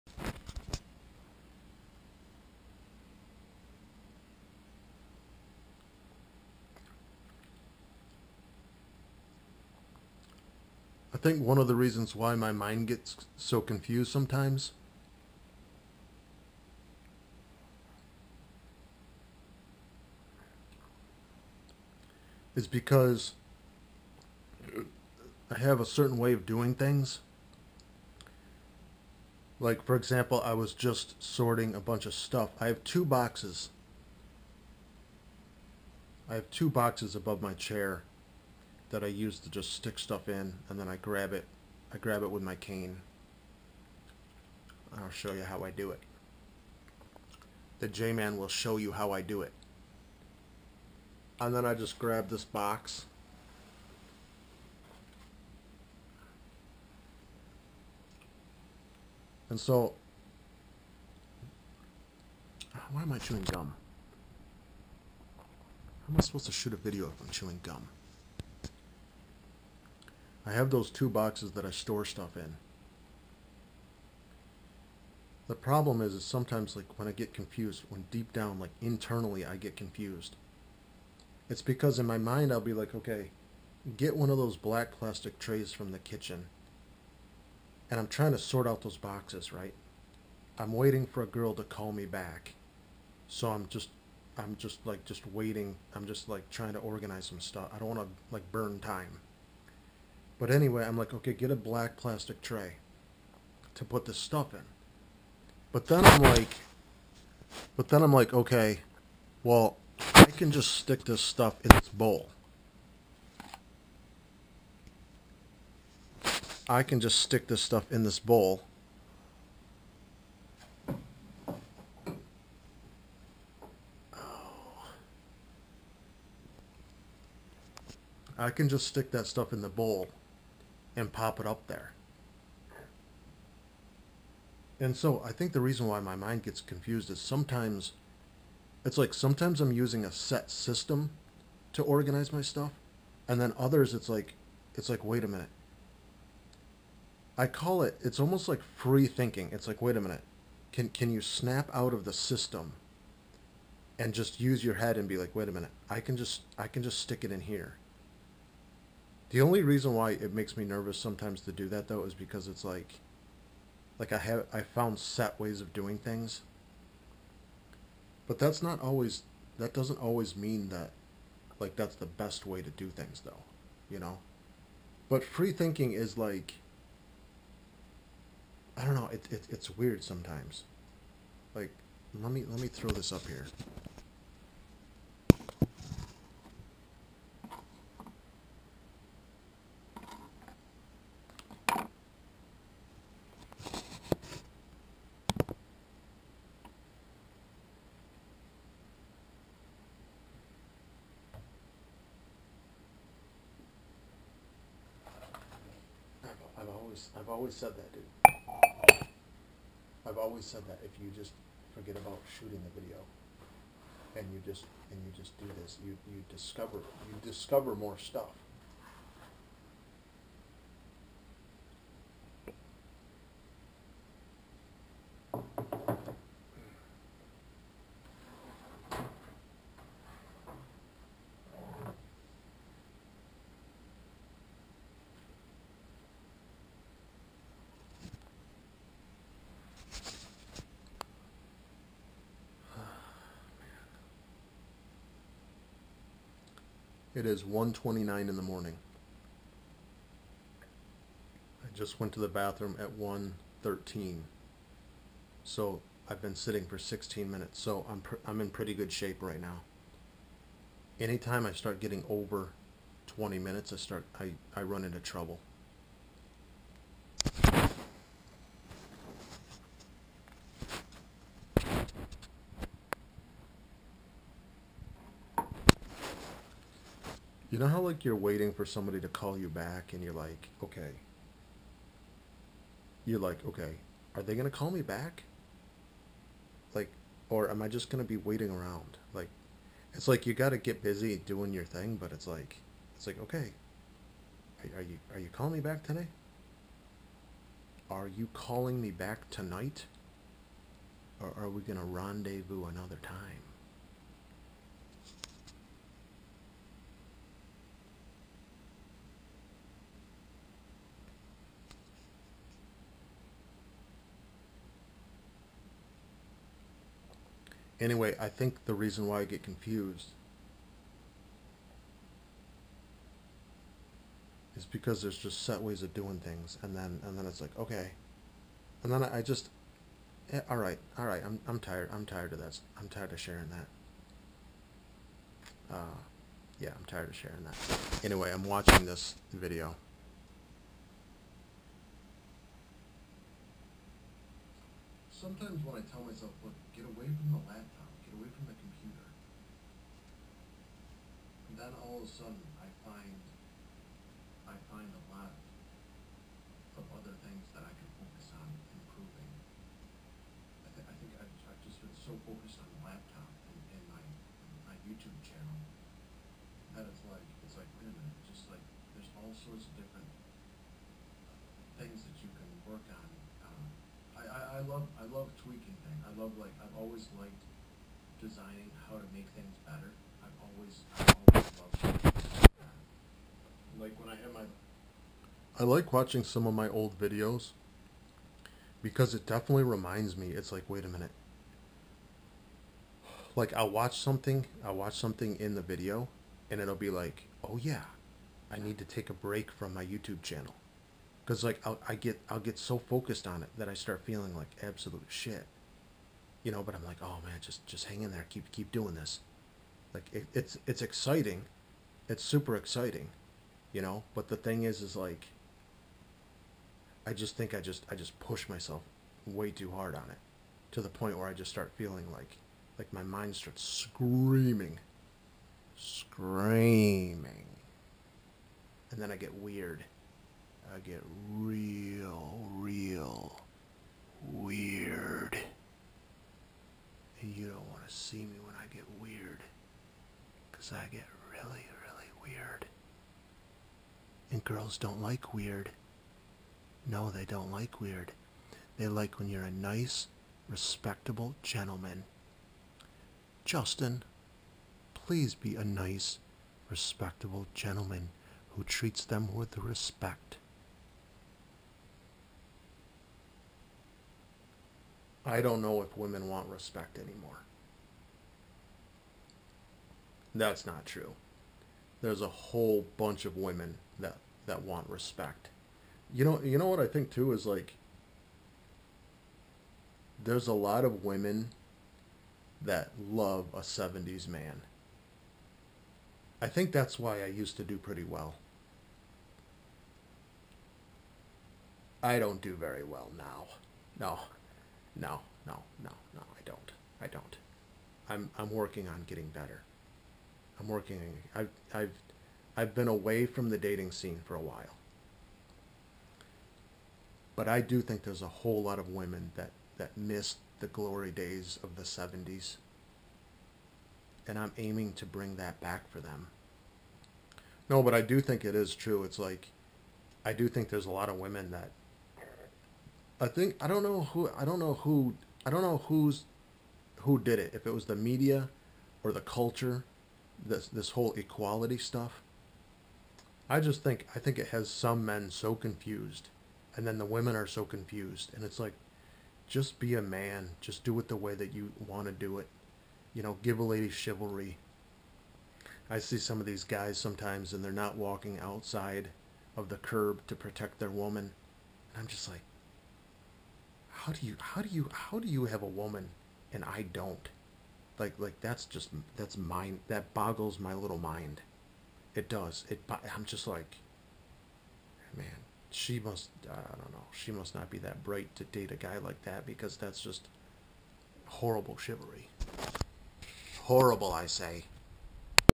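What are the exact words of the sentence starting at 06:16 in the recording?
I love like I've always liked designing how to make things better.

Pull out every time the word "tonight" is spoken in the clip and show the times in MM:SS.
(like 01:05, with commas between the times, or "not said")
04:59.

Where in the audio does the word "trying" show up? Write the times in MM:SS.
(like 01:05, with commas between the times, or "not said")
01:28, 01:36.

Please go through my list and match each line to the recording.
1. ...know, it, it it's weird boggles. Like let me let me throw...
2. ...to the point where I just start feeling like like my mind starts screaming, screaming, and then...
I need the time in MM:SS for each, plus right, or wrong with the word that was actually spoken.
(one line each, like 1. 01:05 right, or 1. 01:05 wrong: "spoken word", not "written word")
1. 02:58 wrong: "sometimes", not "boggles"
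2. 07:00 right.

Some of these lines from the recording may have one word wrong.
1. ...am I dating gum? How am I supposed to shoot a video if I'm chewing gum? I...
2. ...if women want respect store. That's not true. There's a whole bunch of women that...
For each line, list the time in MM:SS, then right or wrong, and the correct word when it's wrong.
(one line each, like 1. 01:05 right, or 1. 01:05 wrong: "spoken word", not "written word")
1. 01:03 wrong: "chewing", not "dating"
2. 07:45 wrong: "anymore", not "store".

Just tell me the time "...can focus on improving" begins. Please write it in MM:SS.
05:57.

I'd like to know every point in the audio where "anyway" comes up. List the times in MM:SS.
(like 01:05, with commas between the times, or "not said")
01:40, 05:17, 05:38.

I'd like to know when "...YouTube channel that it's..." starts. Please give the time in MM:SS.
06:04.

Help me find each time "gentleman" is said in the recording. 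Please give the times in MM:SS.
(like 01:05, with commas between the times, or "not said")
07:31, 07:37.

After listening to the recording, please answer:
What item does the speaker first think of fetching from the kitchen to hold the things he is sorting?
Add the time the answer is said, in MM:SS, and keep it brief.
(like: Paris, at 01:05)
black plastic tray, at 01:24.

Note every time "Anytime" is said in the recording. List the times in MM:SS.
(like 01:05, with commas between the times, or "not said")
04:21.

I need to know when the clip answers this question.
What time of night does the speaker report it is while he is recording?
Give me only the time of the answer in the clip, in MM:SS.
04:07.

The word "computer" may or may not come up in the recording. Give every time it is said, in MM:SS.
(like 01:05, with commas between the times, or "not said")
05:48.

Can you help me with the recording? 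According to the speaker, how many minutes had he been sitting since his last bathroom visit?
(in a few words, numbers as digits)
16.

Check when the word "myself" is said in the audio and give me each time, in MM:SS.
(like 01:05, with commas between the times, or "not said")
05:46, 06:58.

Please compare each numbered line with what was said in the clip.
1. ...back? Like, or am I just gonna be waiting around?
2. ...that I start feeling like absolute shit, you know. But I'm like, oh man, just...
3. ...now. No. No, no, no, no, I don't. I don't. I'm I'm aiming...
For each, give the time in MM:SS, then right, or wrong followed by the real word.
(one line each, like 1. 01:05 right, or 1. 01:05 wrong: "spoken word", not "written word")
1. 04:44 right
2. 06:43 right
3. 08:13 wrong: "working", not "aiming".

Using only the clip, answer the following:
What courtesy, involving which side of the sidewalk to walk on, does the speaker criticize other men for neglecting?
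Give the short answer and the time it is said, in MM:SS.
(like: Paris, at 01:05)
walking outside of the curb, at 09:07.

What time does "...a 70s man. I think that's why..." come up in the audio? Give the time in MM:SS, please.
08:03.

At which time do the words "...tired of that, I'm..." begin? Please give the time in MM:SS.
05:32.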